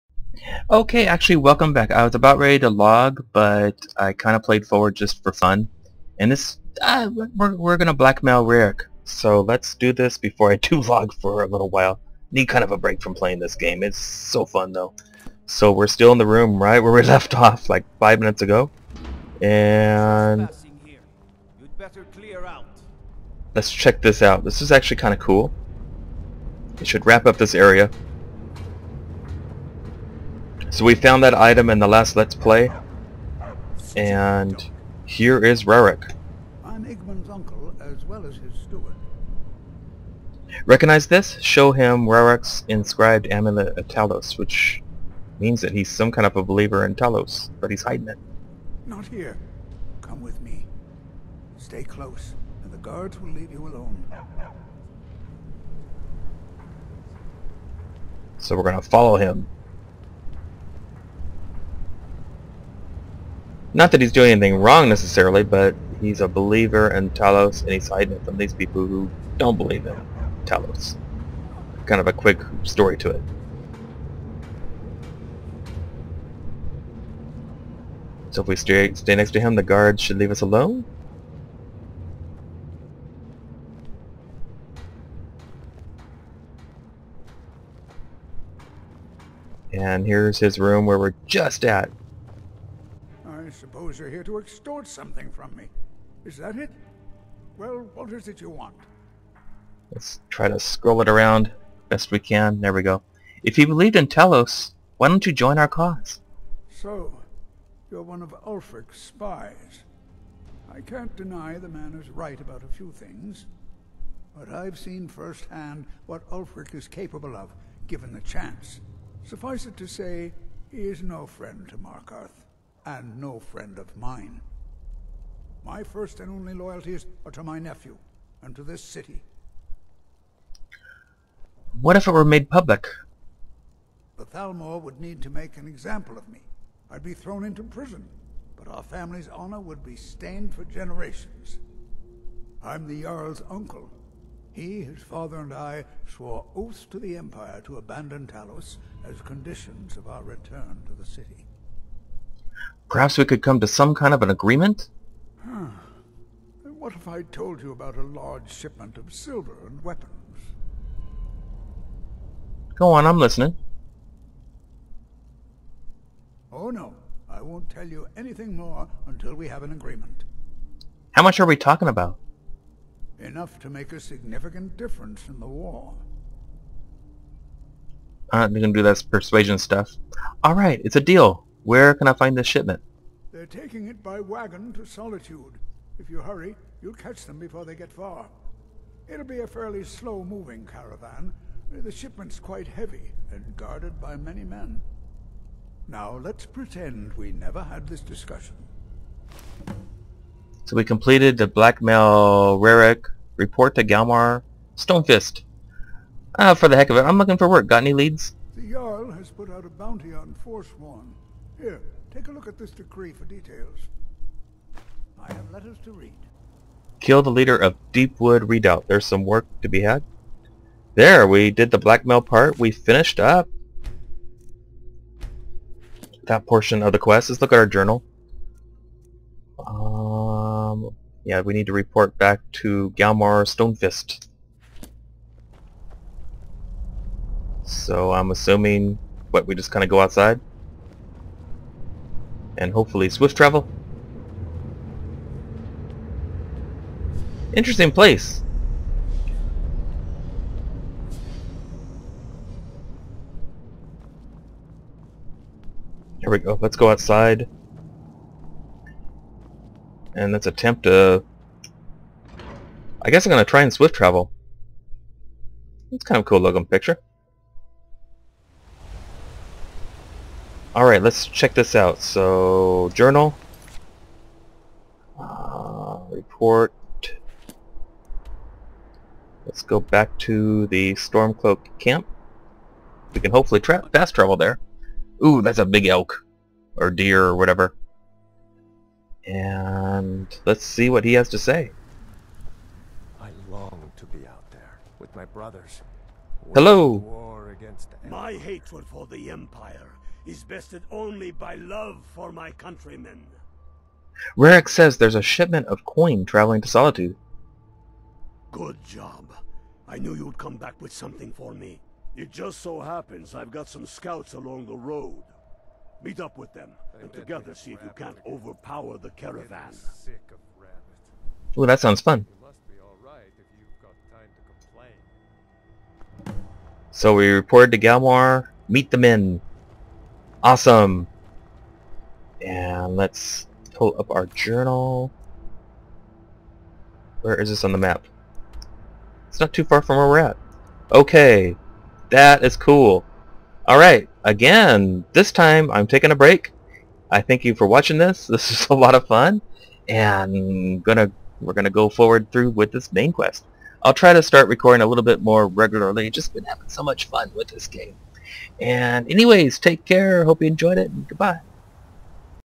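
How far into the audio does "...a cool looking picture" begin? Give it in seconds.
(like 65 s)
266 s.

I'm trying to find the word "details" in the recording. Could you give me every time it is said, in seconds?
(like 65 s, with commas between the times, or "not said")
213 s.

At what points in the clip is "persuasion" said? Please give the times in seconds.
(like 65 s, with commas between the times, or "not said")
179 s.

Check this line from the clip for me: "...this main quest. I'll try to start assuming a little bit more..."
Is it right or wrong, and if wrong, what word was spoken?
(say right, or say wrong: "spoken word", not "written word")
wrong: "recording", not "assuming".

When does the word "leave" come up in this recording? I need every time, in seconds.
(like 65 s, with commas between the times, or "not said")
53 s, 80 s.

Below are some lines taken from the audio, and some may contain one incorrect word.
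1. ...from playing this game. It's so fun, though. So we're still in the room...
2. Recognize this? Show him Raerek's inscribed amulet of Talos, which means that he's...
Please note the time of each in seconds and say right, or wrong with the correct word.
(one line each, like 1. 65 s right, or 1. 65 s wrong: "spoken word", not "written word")
1. 13 s right
2. 40 s right.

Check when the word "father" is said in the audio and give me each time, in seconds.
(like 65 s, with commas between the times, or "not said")
145 s.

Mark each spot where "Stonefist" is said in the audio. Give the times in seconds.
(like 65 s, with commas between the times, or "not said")
204 s, 233 s.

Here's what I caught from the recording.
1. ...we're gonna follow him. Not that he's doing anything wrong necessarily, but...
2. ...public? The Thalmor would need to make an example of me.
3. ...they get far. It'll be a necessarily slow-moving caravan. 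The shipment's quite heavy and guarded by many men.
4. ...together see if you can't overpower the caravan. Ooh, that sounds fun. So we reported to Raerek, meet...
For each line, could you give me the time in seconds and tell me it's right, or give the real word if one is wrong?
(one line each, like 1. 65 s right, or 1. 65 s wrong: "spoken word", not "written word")
1. 58 s right
2. 132 s right
3. 187 s wrong: "fairly", not "necessarily"
4. 317 s wrong: "Galmar", not "Raerek".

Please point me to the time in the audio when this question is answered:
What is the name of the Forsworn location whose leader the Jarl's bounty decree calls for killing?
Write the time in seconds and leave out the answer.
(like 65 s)
217 s.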